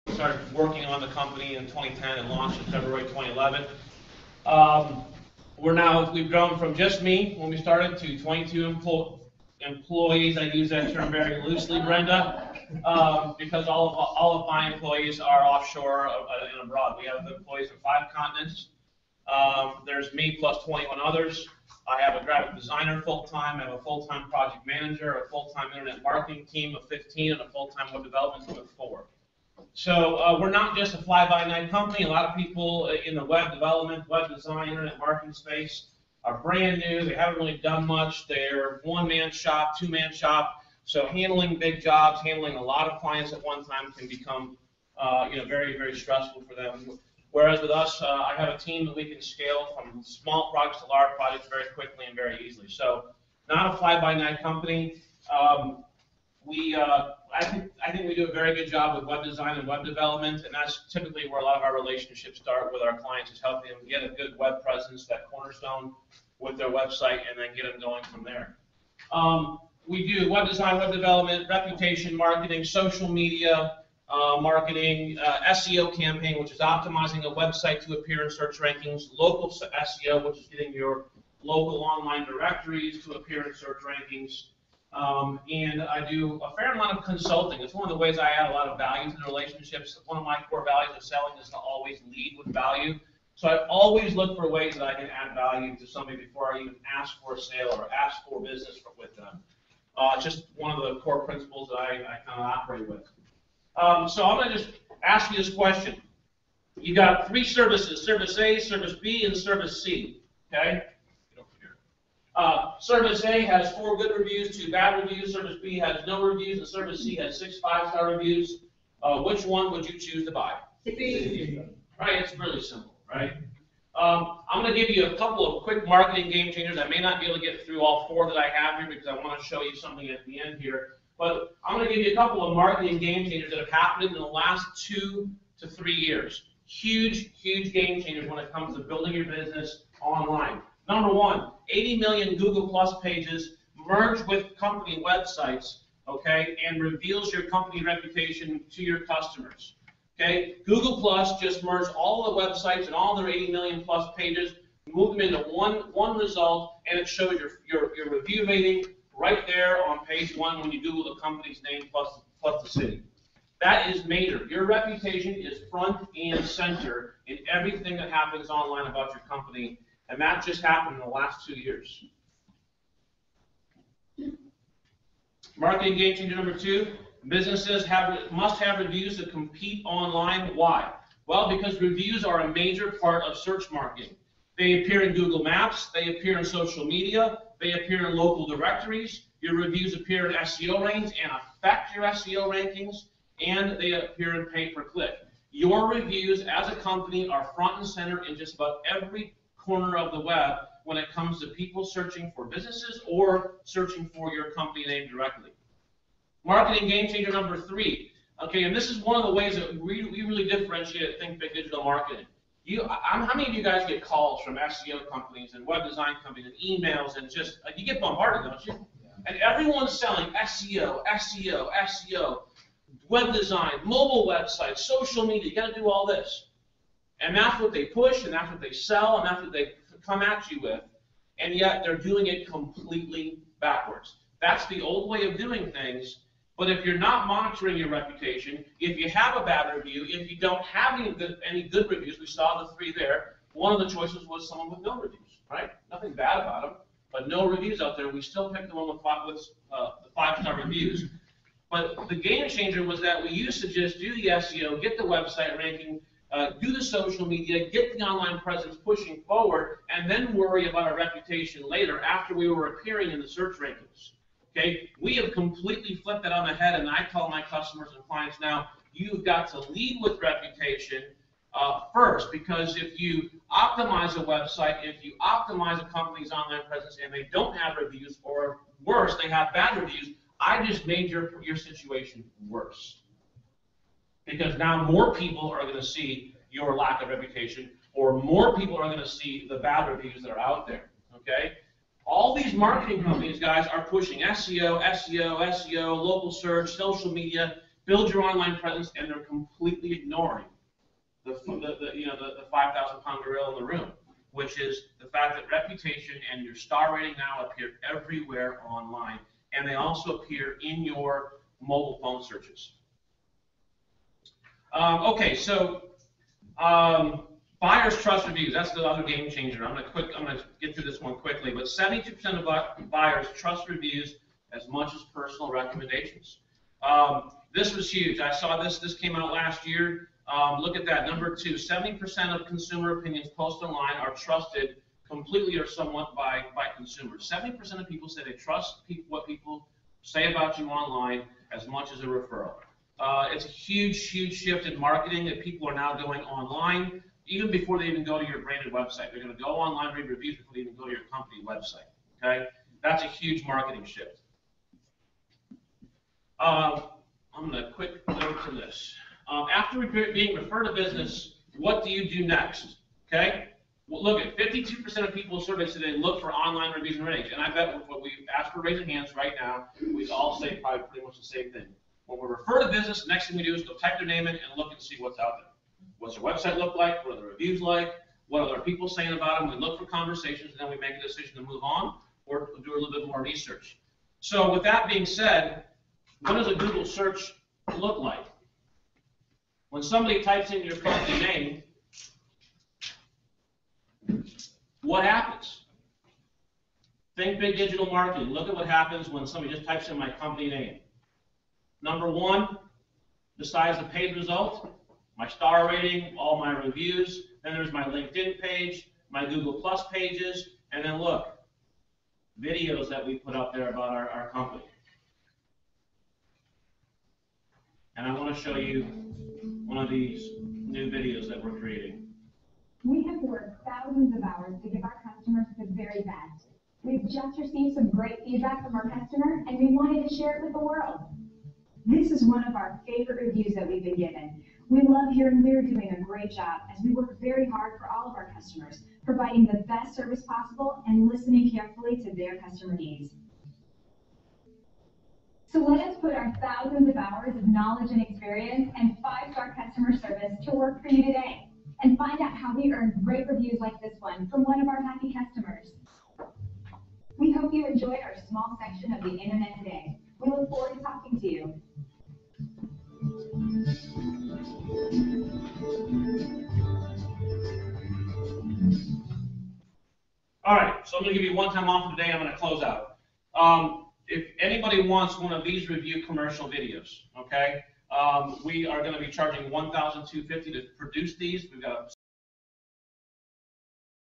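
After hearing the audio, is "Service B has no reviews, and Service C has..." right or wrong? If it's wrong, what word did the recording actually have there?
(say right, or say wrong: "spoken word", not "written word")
right.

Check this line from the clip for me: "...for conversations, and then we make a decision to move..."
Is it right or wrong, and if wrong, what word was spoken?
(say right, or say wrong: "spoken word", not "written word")
right.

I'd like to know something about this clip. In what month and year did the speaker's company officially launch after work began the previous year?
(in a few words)
February 2011.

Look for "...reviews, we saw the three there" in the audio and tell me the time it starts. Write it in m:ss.
4:01.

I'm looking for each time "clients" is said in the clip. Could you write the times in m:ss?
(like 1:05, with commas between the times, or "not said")
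0:43, 1:02, 4:28.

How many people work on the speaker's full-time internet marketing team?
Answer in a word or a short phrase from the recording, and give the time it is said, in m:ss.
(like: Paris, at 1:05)
15, at 0:26.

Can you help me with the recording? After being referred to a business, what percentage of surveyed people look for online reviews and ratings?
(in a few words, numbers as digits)
52%.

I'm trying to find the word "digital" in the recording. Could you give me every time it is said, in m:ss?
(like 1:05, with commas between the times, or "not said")
3:31, 6:37.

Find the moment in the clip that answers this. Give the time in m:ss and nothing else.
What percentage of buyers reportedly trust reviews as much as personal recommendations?
5:21.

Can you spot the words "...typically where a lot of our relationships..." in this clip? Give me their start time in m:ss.
1:00.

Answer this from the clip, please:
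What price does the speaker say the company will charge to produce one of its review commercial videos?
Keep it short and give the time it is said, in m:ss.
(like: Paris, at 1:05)
1,250, at 7:59.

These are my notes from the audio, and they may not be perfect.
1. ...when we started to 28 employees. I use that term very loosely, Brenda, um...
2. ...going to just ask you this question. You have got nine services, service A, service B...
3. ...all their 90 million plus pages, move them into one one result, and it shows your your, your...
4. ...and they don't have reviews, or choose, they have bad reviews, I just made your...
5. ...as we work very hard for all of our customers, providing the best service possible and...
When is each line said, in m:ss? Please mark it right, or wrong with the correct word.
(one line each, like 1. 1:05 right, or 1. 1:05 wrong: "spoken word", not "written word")
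1. 0:07 wrong: "22", not "28"
2. 1:44 wrong: "three", not "nine"
3. 2:32 wrong: "80", not "90"
4. 4:37 wrong: "worse", not "choose"
5. 7:16 right.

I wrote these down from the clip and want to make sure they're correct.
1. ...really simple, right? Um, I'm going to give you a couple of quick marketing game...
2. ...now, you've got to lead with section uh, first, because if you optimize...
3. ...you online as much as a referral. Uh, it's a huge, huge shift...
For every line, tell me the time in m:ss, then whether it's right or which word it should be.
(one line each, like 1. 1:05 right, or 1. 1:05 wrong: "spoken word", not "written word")
1. 2:02 right
2. 4:28 wrong: "reputation", not "section"
3. 5:40 right.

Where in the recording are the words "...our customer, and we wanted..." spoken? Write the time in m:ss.
7:08.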